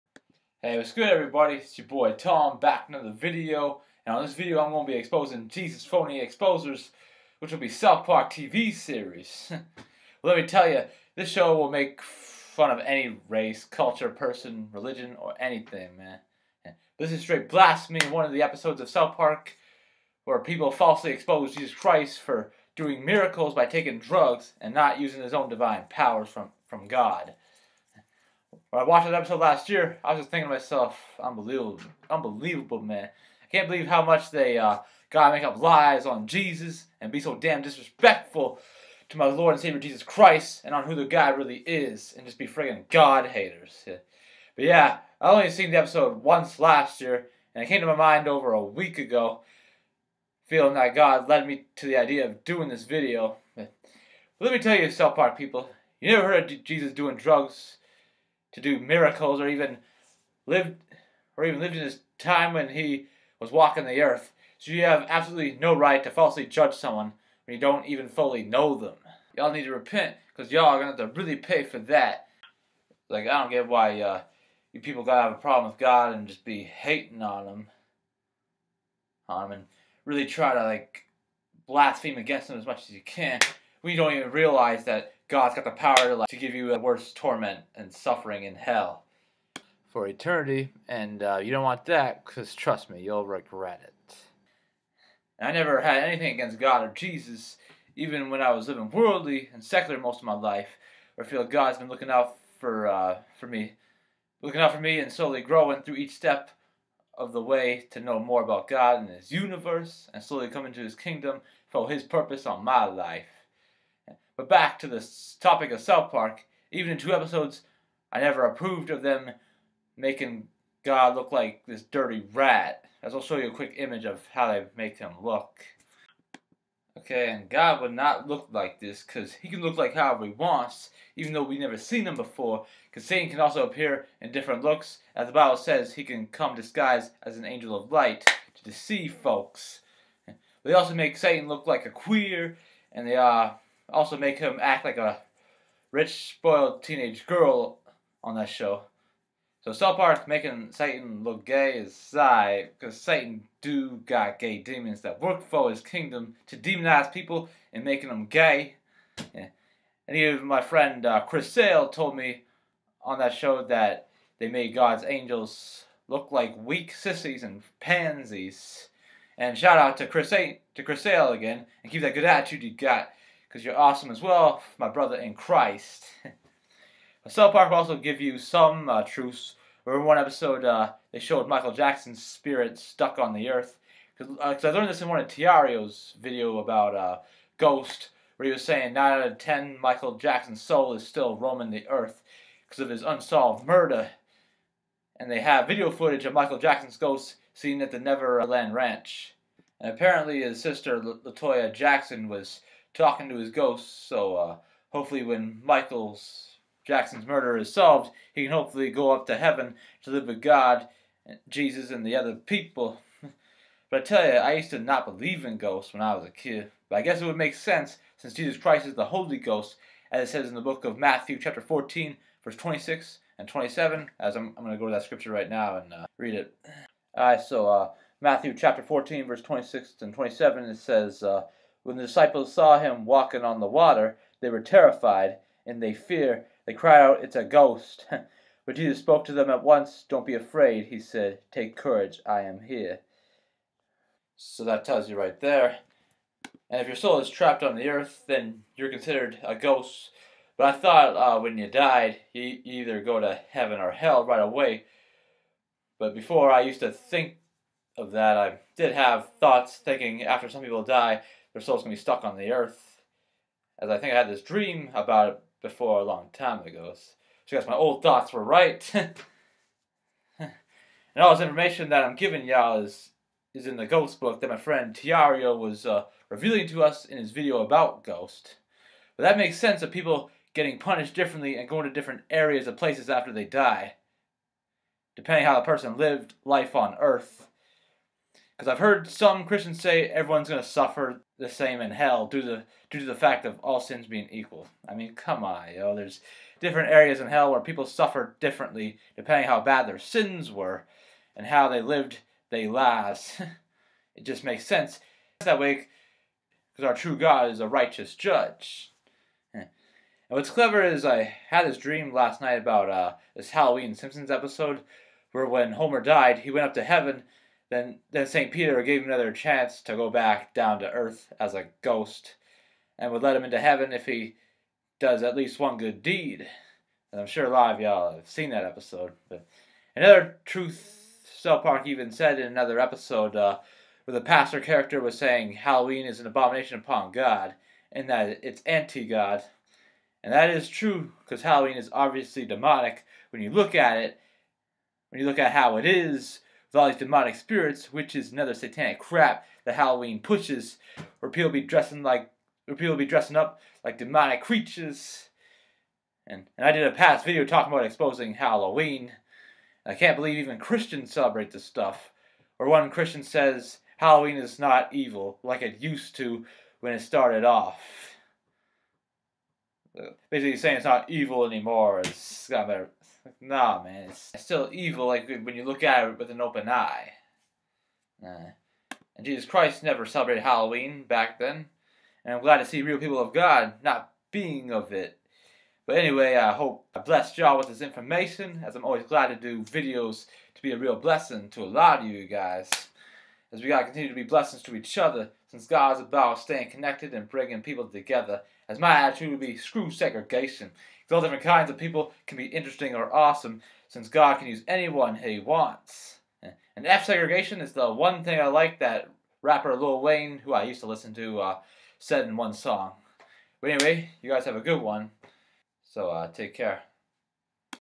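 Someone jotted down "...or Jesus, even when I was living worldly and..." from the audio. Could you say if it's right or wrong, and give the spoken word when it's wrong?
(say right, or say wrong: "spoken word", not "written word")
right.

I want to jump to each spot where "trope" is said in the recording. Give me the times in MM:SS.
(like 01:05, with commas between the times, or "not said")
not said.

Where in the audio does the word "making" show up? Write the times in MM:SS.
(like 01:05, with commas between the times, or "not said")
01:59, 02:30, 02:37.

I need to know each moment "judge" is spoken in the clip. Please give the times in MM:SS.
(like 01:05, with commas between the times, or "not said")
01:06, 05:08.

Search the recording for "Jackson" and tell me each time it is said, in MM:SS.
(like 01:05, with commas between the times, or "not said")
03:01, 03:10, 03:16, 03:21, 03:26.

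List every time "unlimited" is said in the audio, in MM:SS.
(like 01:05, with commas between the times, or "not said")
not said.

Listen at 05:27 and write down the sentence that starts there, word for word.
And I'm sure a lot of y'all have seen that episode.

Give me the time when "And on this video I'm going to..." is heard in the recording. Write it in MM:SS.
00:04.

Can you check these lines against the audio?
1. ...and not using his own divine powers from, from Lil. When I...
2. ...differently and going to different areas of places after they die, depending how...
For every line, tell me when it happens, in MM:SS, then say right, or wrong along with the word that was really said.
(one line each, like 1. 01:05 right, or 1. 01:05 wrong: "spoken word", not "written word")
1. 00:24 wrong: "God", not "Lil"
2. 04:41 right.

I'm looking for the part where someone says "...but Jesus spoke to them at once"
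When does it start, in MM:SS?
03:58.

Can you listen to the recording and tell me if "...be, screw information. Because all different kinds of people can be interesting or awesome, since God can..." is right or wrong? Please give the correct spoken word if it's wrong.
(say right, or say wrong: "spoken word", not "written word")
wrong: "segregation", not "information".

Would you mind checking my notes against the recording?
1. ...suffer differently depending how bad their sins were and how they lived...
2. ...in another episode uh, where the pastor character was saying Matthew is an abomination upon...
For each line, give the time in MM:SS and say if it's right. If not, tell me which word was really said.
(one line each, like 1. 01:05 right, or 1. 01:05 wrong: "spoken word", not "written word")
1. 04:57 right
2. 05:32 wrong: "Halloween", not "Matthew".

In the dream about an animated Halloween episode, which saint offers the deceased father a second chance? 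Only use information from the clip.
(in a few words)
St. Peter.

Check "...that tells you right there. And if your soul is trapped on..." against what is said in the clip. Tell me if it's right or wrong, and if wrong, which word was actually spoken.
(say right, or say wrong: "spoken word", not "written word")
right.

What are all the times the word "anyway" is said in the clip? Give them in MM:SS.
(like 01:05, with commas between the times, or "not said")
06:25, 06:53.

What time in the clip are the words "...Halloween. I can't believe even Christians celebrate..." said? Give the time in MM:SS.
05:58.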